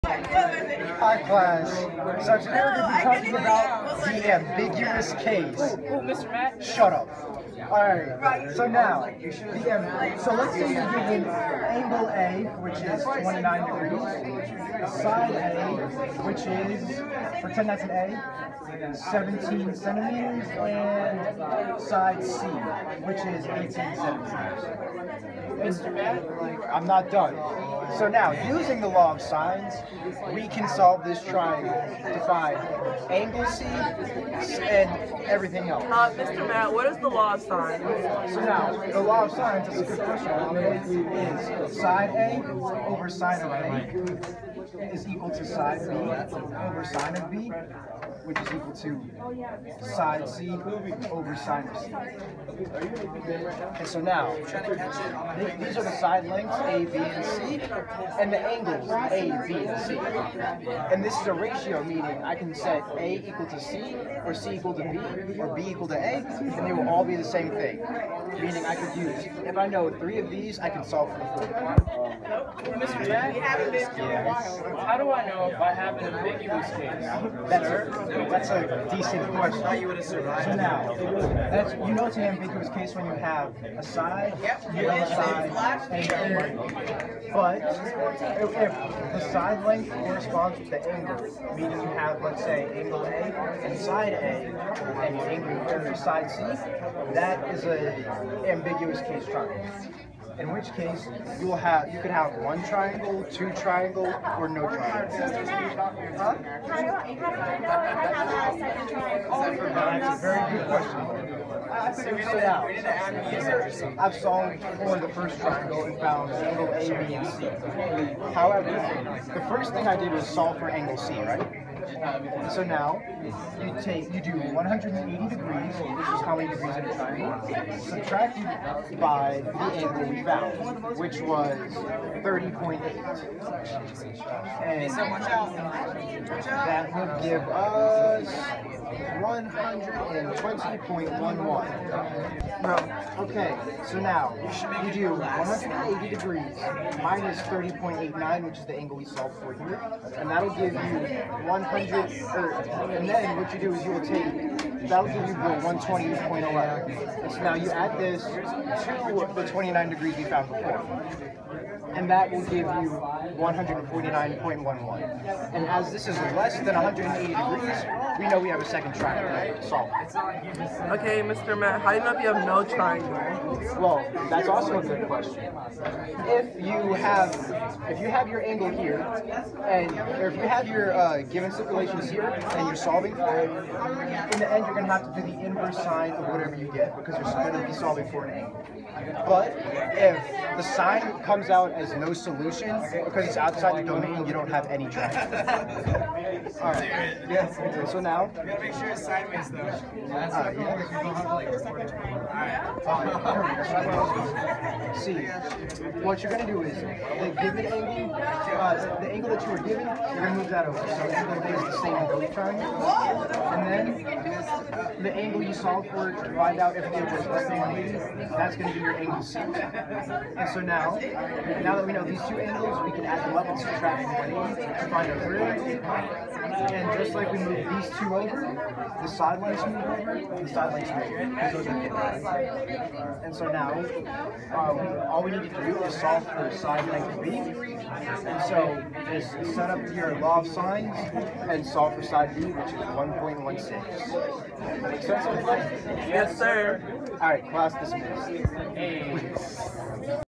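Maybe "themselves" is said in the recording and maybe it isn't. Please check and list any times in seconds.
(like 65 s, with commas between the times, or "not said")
not said.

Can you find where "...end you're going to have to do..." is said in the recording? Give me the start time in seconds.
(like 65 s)
184 s.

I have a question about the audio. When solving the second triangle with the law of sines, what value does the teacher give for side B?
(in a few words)
1.16.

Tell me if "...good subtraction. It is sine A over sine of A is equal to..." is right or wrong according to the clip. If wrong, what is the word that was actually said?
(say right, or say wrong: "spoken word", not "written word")
wrong: "question", not "subtraction".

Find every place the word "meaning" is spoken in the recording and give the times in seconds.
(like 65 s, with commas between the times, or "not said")
61 s, 68 s, 91 s.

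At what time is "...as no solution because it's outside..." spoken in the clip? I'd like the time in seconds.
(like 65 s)
191 s.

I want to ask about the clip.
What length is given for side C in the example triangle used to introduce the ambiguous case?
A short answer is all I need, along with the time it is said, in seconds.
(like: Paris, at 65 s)
18 centimeters, at 23 s.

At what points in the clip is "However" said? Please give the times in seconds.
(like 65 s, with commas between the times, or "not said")
118 s.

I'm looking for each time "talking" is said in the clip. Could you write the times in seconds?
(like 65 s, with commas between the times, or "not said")
3 s.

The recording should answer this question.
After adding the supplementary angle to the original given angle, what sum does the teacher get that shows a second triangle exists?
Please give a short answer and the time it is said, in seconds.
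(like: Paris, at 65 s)
149.11, at 163 s.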